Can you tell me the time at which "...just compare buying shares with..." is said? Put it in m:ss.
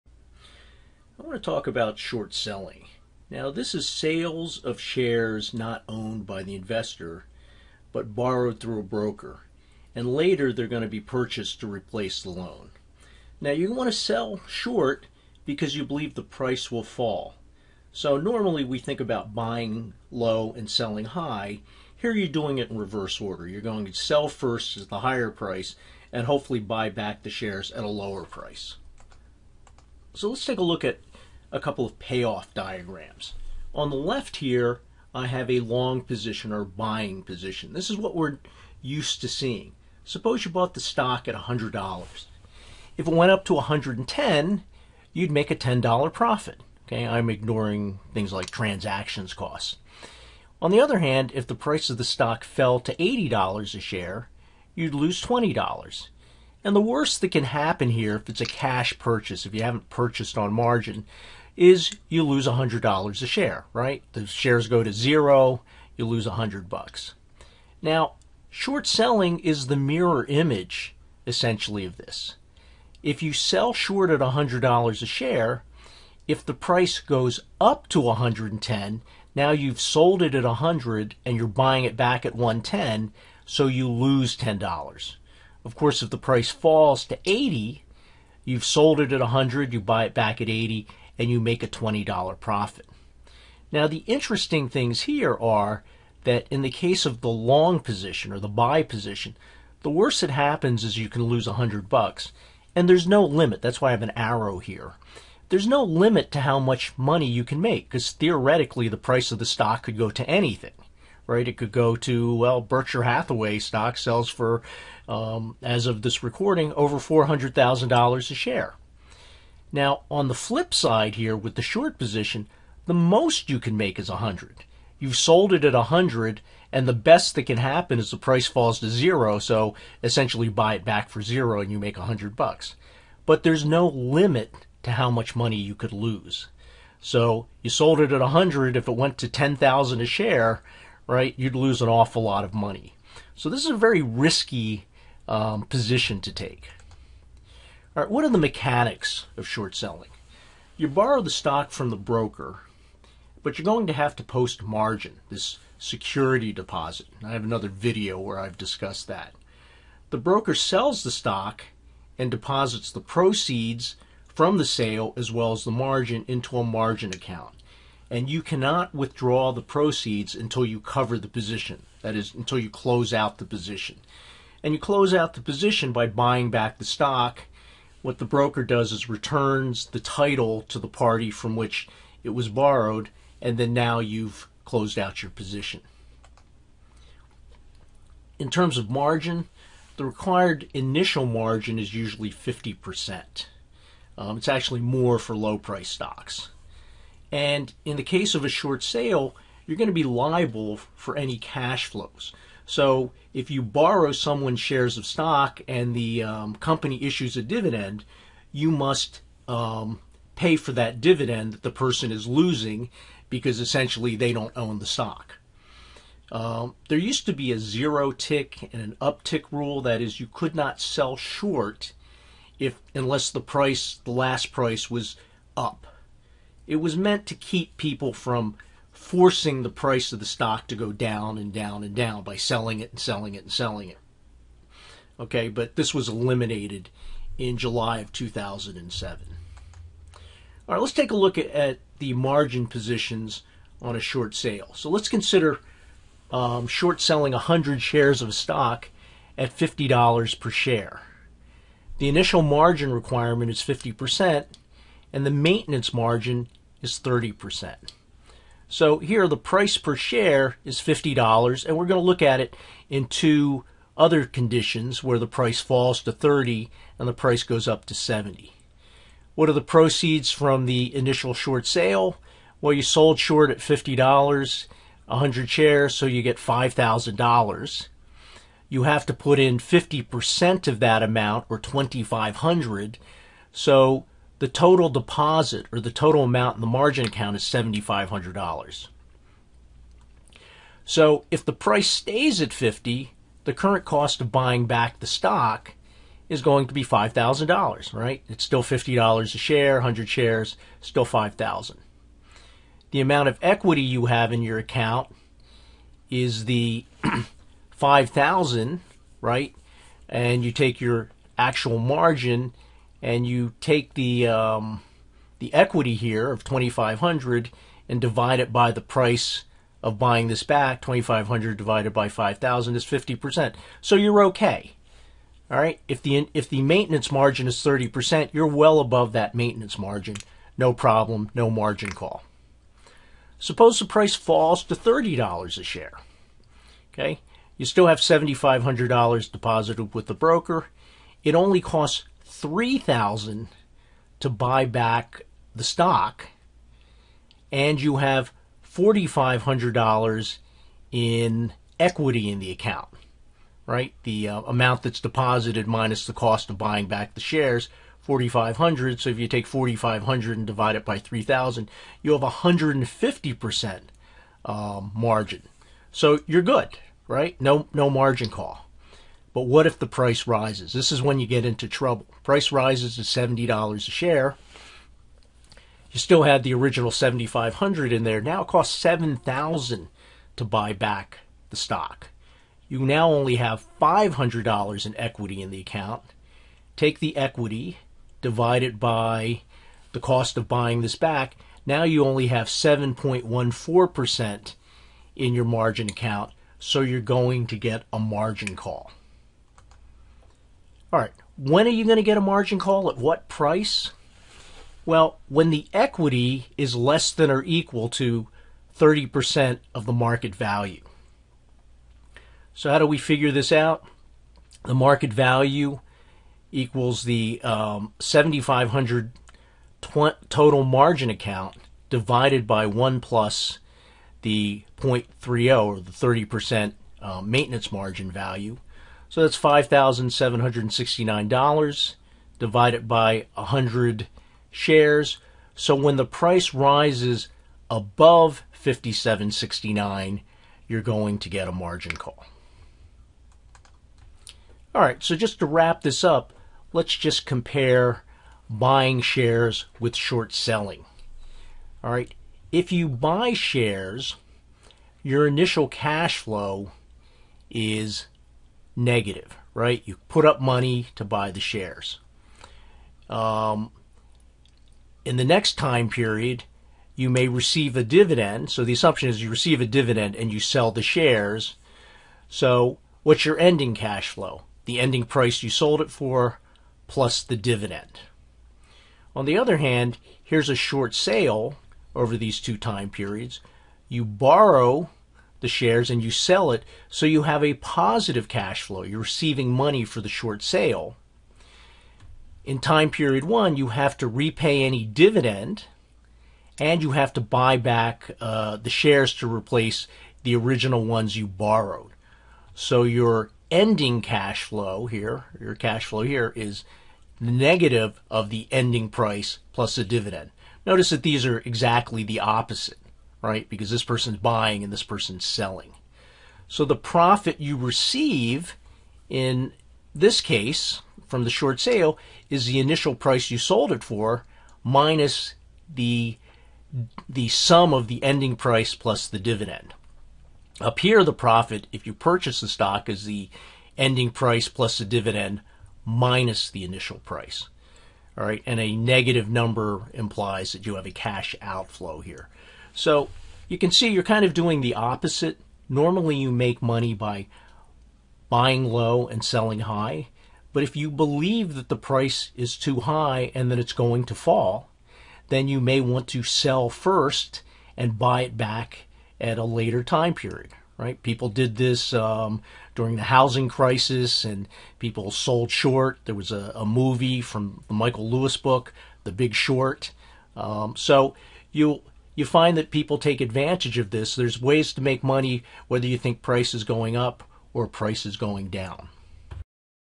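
7:26.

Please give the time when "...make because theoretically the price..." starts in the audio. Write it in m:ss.
1:47.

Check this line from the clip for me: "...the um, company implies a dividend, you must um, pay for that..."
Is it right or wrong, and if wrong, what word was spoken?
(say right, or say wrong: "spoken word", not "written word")
wrong: "issues", not "implies".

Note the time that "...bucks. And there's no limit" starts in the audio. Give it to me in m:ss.
1:41.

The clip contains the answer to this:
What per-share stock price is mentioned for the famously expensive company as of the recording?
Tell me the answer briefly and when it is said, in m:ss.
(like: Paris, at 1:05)
over $400,000, at 1:56.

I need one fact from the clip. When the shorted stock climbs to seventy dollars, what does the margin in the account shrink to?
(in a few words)
7.14%.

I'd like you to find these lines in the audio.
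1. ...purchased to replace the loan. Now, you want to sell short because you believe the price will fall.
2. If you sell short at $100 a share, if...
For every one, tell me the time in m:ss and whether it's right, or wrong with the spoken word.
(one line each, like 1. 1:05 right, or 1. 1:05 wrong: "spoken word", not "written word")
1. 0:10 right
2. 1:13 right.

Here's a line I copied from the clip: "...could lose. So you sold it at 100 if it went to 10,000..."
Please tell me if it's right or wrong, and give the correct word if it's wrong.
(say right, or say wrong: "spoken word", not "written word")
right.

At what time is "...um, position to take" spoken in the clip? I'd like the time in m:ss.
2:25.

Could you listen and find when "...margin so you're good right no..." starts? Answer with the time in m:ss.
6:04.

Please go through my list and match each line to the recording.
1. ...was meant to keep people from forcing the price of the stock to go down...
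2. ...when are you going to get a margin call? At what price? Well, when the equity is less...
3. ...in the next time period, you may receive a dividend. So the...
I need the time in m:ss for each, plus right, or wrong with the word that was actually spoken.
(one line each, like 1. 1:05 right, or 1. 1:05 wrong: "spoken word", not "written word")
1. 3:46 right
2. 6:41 right
3. 7:45 right.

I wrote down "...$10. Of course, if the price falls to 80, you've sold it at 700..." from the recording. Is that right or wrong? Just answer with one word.
wrong.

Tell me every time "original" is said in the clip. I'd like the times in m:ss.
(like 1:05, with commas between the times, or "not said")
6:16, 8:20.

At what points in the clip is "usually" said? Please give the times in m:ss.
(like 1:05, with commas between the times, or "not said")
3:11.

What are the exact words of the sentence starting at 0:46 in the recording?
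Okay, I'm ignoring things like transactions costs.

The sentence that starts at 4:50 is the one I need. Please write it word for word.
So if the price stays at 50, the current cost of buying back the stock is going to be $5,000, right?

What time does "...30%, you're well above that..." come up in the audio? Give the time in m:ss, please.
5:27.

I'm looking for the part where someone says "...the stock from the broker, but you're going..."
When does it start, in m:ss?
2:31.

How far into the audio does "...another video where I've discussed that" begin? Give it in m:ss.
2:37.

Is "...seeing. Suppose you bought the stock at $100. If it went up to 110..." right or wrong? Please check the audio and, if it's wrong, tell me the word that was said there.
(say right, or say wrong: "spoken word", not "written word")
right.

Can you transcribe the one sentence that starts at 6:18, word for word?
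Now it costs 7000 to buy back the stock.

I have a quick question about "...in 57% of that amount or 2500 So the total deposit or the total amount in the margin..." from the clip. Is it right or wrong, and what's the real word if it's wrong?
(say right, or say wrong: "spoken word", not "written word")
wrong: "50", not "57".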